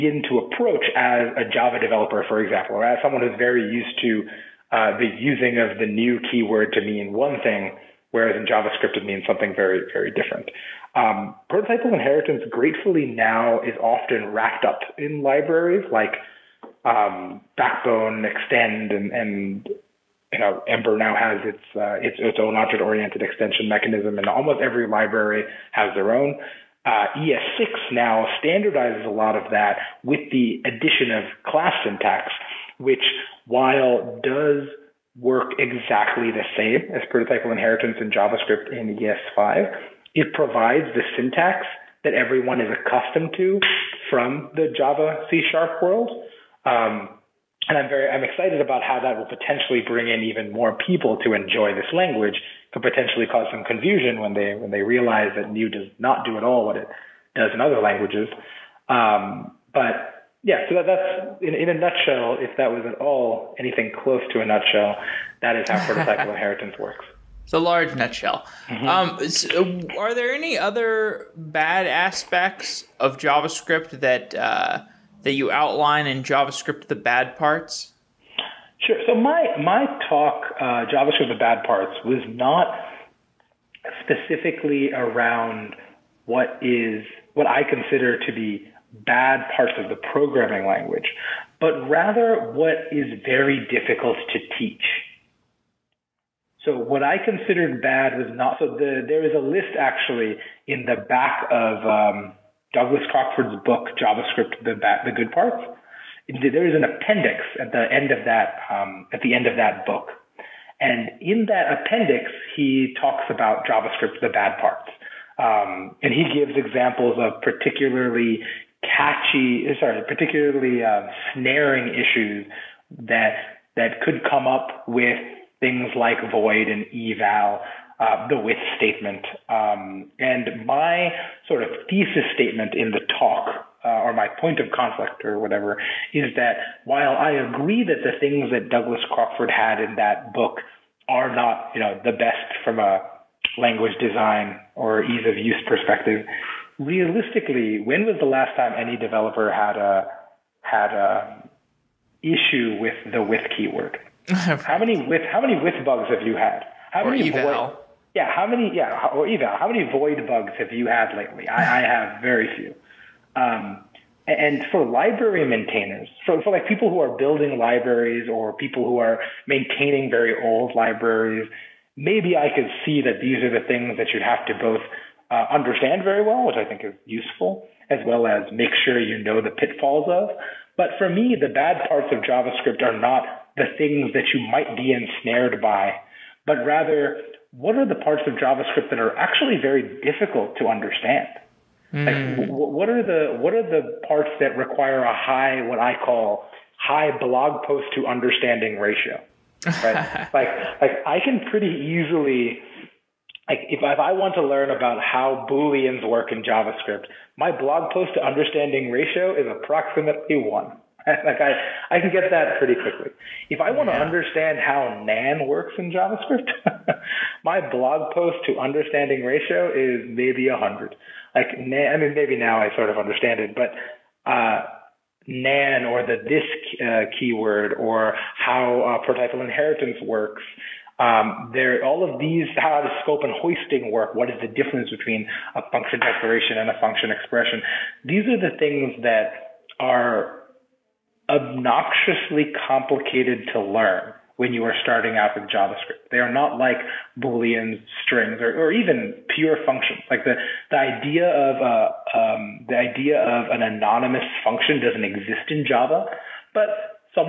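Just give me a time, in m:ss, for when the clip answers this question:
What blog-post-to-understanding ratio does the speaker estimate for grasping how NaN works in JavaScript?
3:40.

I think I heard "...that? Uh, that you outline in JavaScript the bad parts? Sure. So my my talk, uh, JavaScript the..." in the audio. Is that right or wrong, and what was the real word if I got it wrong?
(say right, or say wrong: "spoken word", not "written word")
right.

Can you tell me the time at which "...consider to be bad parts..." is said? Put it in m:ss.
1:27.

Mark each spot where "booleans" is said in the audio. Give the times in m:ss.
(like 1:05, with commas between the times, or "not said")
3:25, 4:07.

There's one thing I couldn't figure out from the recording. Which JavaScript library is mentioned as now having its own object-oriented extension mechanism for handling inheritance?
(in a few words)
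Ember.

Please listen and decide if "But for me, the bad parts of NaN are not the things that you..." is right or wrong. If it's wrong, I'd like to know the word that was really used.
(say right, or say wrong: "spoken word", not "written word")
wrong: "JavaScript", not "NaN".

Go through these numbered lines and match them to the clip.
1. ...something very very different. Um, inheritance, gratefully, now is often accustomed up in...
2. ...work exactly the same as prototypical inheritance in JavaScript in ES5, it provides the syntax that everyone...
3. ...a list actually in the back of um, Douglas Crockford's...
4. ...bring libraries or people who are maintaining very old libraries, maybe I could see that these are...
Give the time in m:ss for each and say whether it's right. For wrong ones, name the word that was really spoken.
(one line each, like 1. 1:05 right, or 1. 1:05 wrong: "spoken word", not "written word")
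1. 0:09 wrong: "wrapped", not "accustomed"
2. 0:35 right
3. 1:39 right
4. 2:47 wrong: "building", not "bring".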